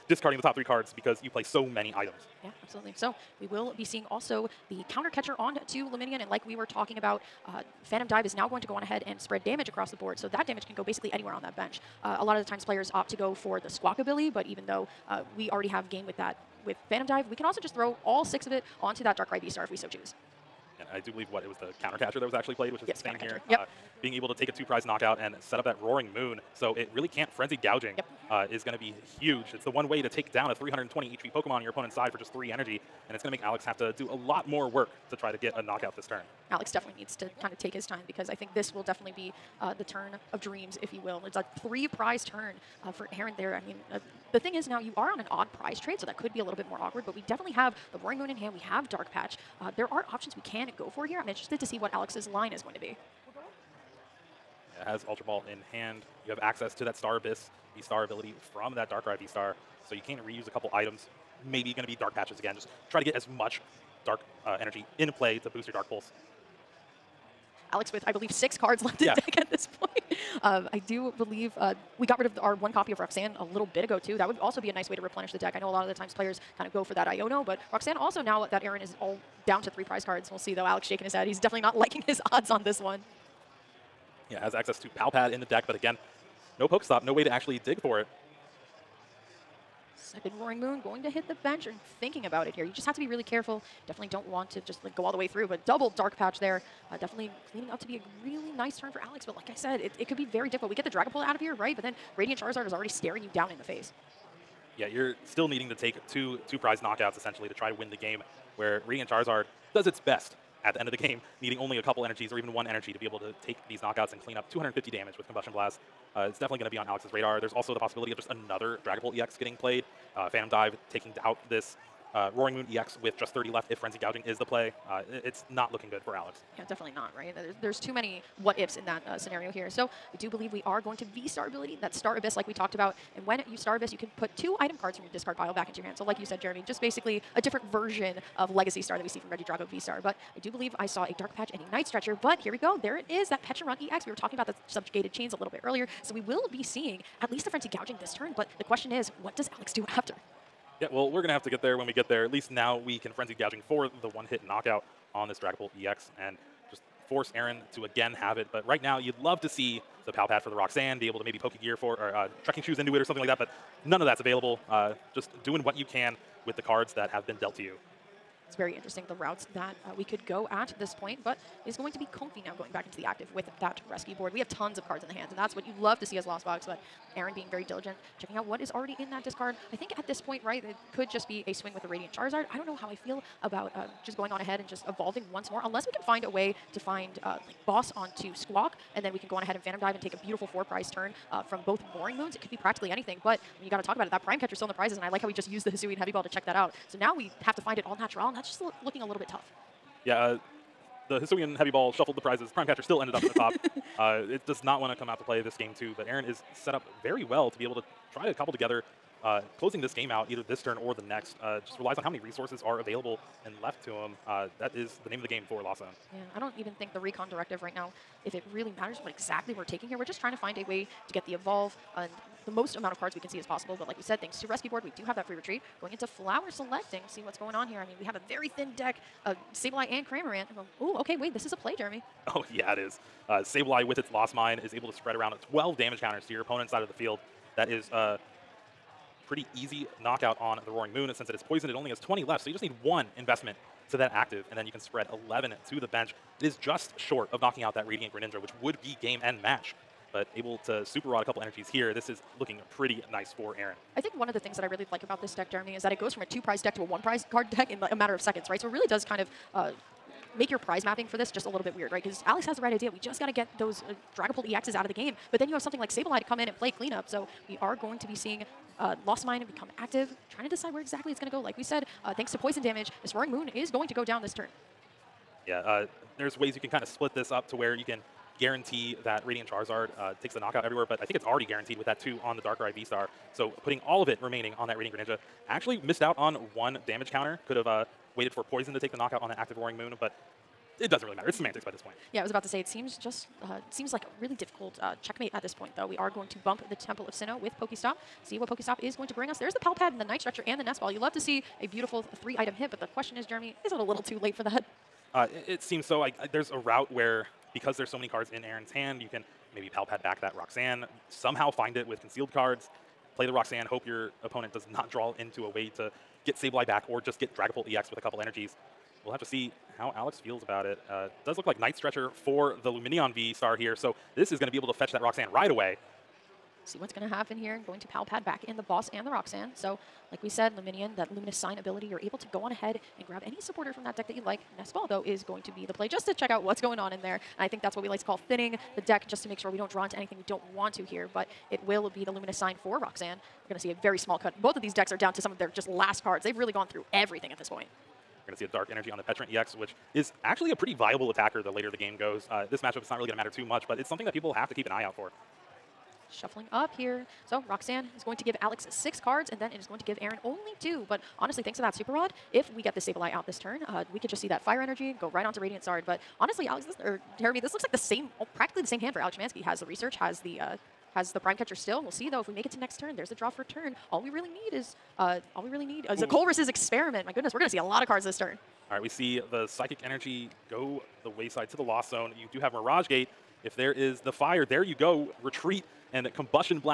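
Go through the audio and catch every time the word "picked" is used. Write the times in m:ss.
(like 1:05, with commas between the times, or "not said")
not said.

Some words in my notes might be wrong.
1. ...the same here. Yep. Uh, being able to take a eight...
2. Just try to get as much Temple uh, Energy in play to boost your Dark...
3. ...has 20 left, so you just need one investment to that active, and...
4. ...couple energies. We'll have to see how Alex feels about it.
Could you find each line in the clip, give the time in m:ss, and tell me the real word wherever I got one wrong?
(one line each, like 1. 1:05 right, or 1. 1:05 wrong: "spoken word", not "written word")
1. 0:23 wrong: "two", not "eight"
2. 1:02 wrong: "Dark", not "Temple"
3. 4:01 right
4. 5:18 right.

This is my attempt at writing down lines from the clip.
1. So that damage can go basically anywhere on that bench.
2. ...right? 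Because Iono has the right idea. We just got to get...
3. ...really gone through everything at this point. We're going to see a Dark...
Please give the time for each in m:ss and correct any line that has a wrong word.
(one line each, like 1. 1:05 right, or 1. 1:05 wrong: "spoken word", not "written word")
1. 0:10 right
2. 4:21 wrong: "Alex", not "Iono"
3. 5:46 right.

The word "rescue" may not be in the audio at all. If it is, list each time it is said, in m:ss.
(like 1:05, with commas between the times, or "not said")
2:53, 3:44.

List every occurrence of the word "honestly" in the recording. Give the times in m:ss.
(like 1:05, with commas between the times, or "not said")
6:01, 6:06.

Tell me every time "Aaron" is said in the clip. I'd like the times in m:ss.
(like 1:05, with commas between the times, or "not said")
0:43, 1:18, 2:37, 2:57, 3:26, 4:13, 5:08, 6:00.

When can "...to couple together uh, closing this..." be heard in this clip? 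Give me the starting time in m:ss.
3:28.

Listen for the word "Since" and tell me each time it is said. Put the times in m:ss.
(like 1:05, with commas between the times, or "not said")
4:01.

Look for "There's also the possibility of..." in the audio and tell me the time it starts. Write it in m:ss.
1:57.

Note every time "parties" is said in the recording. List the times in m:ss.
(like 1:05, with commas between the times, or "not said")
not said.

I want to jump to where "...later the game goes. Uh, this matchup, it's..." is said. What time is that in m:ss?
5:51.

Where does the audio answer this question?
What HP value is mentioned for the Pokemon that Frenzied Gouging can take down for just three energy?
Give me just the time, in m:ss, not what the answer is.
0:30.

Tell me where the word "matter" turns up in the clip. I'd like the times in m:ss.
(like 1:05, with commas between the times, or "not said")
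3:38, 4:17, 4:51, 5:53.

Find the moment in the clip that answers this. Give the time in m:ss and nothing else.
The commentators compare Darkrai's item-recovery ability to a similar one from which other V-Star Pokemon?
2:19.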